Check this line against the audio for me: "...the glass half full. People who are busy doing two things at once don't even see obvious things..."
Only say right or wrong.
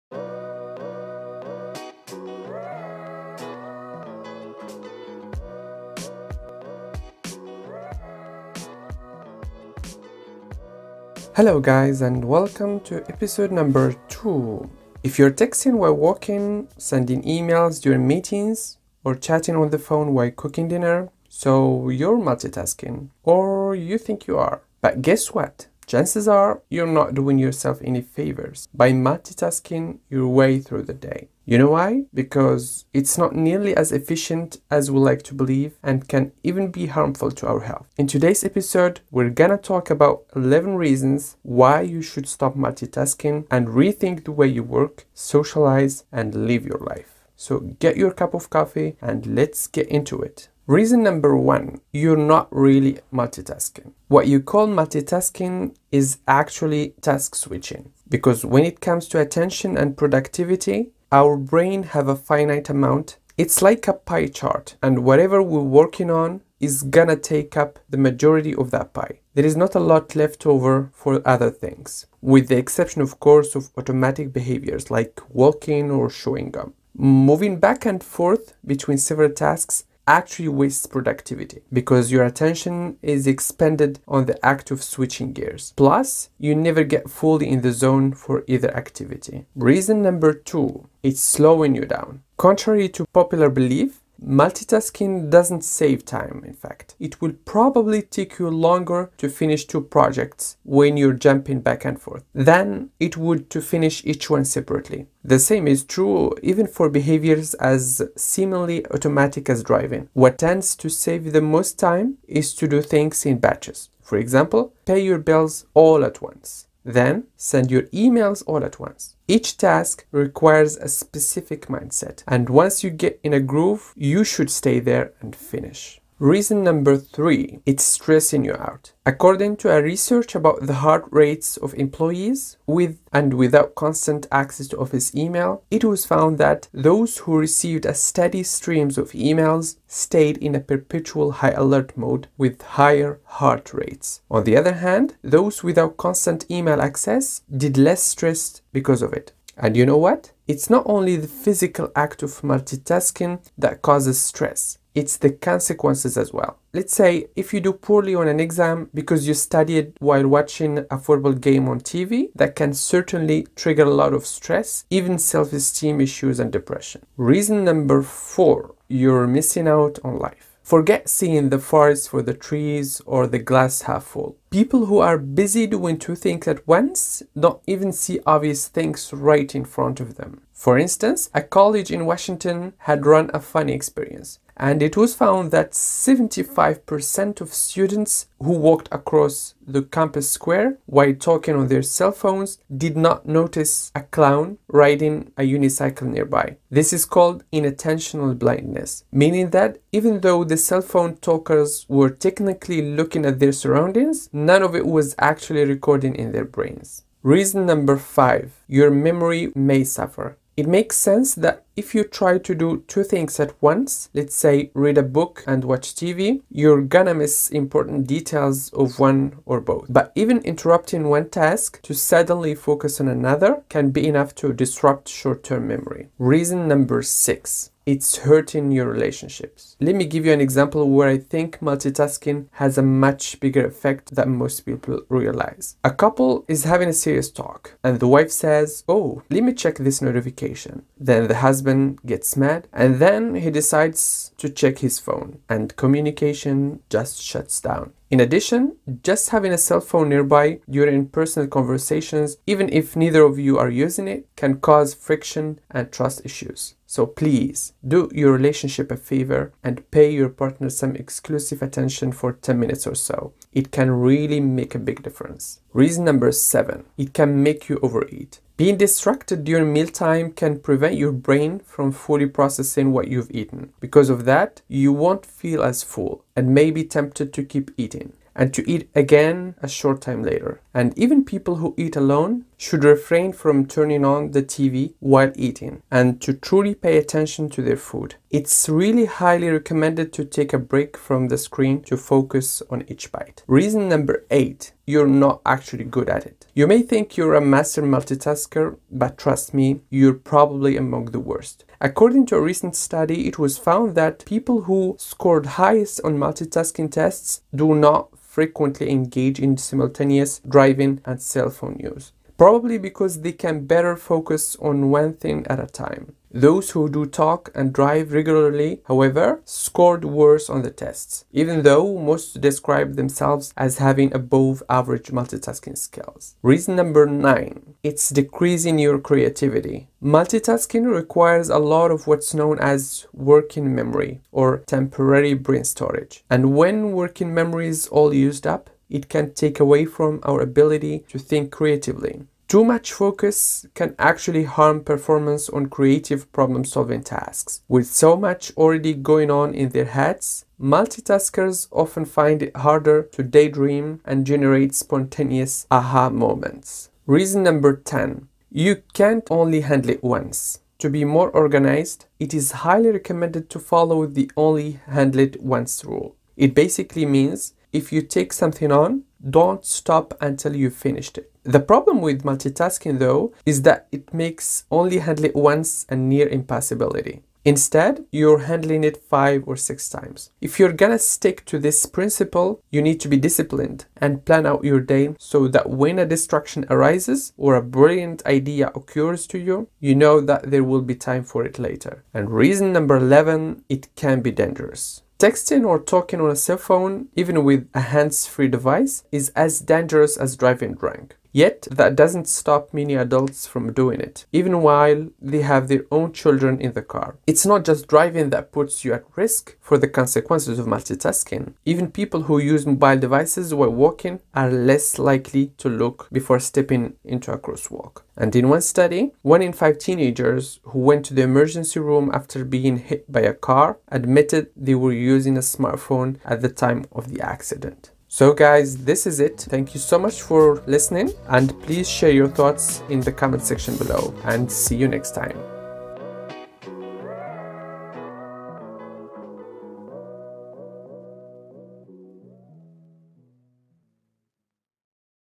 right.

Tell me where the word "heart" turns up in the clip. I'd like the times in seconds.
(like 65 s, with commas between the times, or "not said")
130 s, 143 s.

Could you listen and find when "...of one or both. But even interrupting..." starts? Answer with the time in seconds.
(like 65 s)
218 s.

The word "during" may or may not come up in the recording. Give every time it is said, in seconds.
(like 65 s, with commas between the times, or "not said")
17 s, 250 s, 269 s.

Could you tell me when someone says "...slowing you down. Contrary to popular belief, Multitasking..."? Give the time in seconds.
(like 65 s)
91 s.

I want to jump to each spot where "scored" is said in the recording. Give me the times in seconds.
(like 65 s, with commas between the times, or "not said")
304 s, 319 s.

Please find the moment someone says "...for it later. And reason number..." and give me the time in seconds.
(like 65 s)
391 s.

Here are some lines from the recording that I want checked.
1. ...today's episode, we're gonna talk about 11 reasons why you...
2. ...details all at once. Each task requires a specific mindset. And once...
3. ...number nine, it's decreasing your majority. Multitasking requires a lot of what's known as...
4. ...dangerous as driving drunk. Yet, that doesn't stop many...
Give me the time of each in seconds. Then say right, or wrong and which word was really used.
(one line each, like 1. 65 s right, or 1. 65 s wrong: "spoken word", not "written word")
1. 38 s right
2. 117 s wrong: "emails", not "details"
3. 326 s wrong: "creativity", not "majority"
4. 399 s right.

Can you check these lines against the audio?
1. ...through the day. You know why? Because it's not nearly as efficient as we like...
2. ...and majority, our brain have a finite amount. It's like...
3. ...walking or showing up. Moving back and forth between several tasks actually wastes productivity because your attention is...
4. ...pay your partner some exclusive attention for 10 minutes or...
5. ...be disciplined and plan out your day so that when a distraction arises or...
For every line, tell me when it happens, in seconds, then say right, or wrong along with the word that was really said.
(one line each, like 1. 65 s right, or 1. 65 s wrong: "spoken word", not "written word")
1. 30 s right
2. 59 s wrong: "productivity", not "majority"
3. 75 s right
4. 259 s right
5. 383 s right.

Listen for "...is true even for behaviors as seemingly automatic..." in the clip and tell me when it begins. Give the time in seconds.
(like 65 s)
105 s.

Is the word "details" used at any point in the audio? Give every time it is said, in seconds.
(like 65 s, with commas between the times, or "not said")
218 s.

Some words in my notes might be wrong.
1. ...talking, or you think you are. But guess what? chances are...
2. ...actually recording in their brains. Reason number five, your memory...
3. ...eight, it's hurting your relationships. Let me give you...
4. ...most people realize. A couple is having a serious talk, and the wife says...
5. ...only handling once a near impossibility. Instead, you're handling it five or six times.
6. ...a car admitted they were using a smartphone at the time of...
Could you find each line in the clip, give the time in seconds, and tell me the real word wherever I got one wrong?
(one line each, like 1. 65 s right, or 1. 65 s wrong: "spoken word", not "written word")
1. 22 s wrong: "multitasking", not "talking"
2. 205 s right
3. 227 s wrong: "six", not "eight"
4. 234 s right
5. 374 s right
6. 423 s right.